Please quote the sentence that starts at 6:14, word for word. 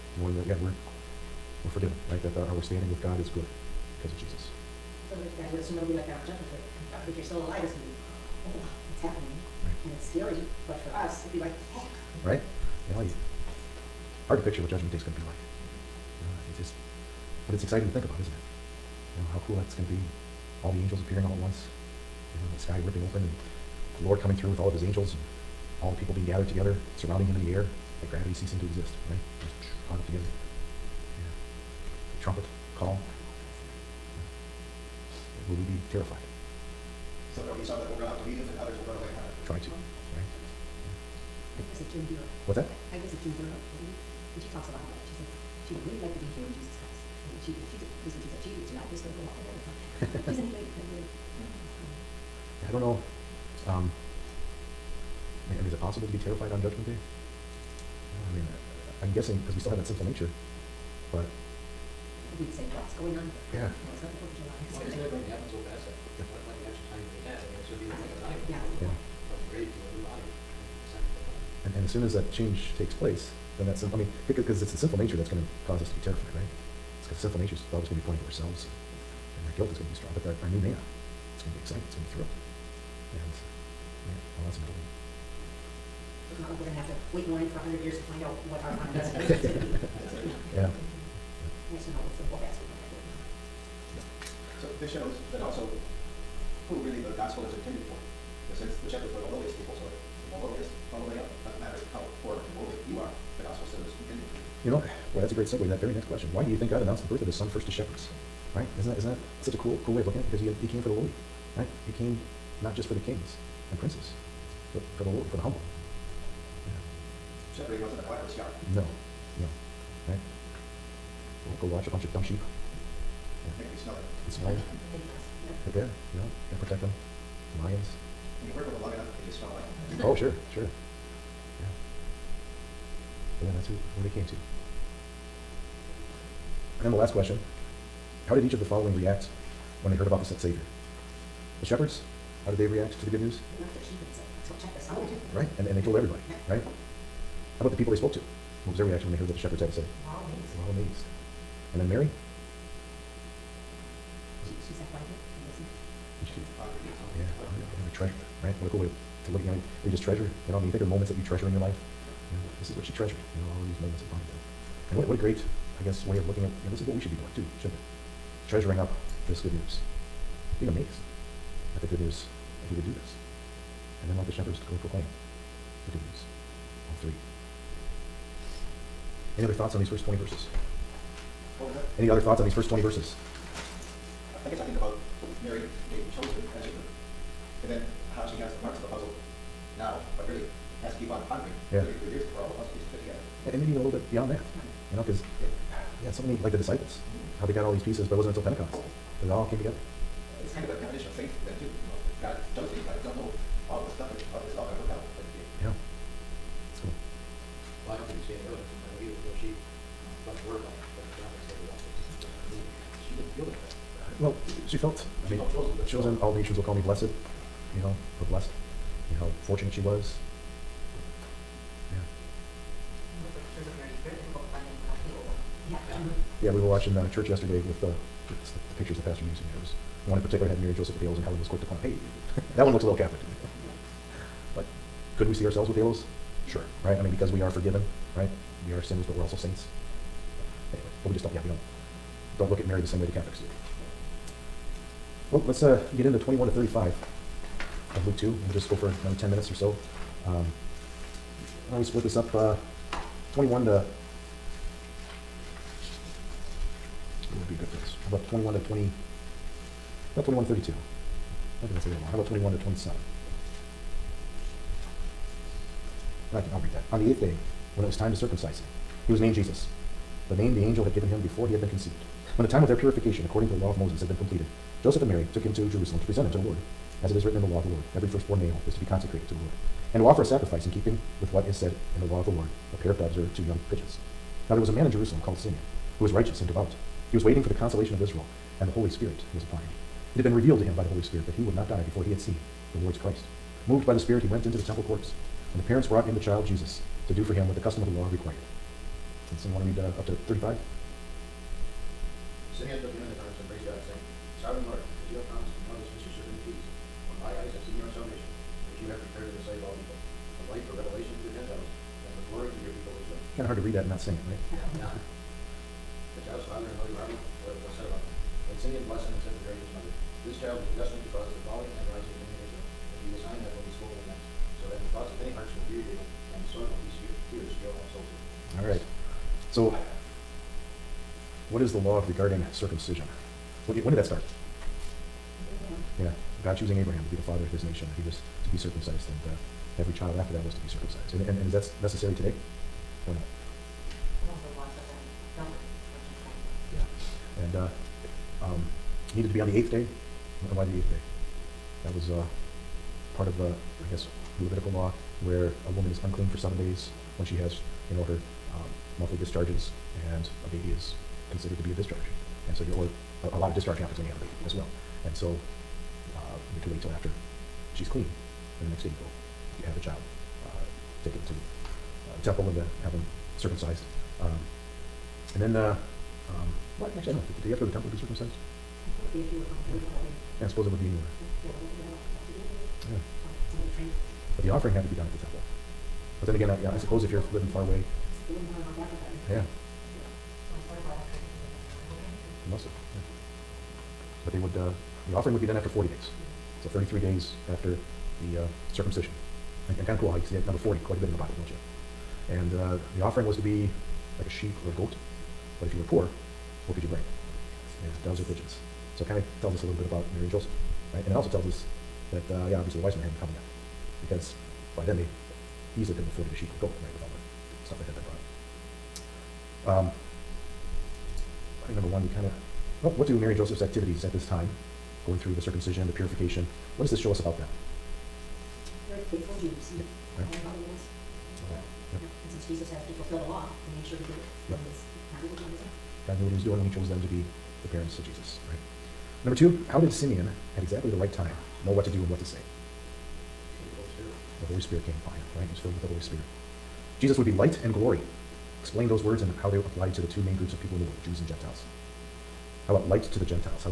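Um, and then, uh, um, well, actually, I don't know.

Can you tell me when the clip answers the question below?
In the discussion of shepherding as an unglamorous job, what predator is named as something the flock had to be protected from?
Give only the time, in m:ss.
2:07.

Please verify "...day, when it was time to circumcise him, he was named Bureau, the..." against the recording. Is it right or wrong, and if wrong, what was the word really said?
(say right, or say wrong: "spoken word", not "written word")
wrong: "Jesus", not "Bureau".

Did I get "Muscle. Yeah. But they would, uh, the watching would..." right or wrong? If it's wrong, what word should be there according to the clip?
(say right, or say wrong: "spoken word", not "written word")
wrong: "offering", not "watching".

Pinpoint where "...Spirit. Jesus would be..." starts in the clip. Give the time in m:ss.
7:26.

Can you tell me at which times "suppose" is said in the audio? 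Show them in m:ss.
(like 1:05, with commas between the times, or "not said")
6:20, 6:26.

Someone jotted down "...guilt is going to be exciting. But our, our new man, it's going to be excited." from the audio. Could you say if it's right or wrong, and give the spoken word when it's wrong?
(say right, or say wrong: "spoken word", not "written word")
wrong: "strong", not "exciting".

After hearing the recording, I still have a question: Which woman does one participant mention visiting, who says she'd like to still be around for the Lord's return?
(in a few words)
June Bureau.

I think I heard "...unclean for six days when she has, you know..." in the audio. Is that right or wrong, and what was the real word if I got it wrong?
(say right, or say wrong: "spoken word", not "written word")
wrong: "seven", not "six".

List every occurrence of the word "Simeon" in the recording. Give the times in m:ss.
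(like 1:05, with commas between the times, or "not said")
4:45, 5:02, 7:19.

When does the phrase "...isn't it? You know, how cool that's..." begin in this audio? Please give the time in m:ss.
0:18.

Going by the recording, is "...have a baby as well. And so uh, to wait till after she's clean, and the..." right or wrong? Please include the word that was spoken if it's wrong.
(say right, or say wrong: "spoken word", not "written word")
right.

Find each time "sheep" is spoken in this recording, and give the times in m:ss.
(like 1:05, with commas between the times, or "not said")
2:02, 6:44, 6:56.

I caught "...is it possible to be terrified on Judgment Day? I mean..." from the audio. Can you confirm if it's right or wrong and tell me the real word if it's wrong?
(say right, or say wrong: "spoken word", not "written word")
right.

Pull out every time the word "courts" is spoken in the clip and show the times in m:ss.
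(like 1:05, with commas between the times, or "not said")
4:54.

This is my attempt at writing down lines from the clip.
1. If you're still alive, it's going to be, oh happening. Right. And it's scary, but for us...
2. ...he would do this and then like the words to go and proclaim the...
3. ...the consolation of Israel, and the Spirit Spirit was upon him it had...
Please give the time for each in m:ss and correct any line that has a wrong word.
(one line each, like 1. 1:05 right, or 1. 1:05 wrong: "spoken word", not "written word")
1. 0:07 right
2. 2:52 wrong: "shepherds", not "words"
3. 4:47 wrong: "Holy", not "Spirit".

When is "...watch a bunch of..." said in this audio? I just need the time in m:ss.
2:01.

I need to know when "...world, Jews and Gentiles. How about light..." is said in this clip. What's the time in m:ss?
7:30.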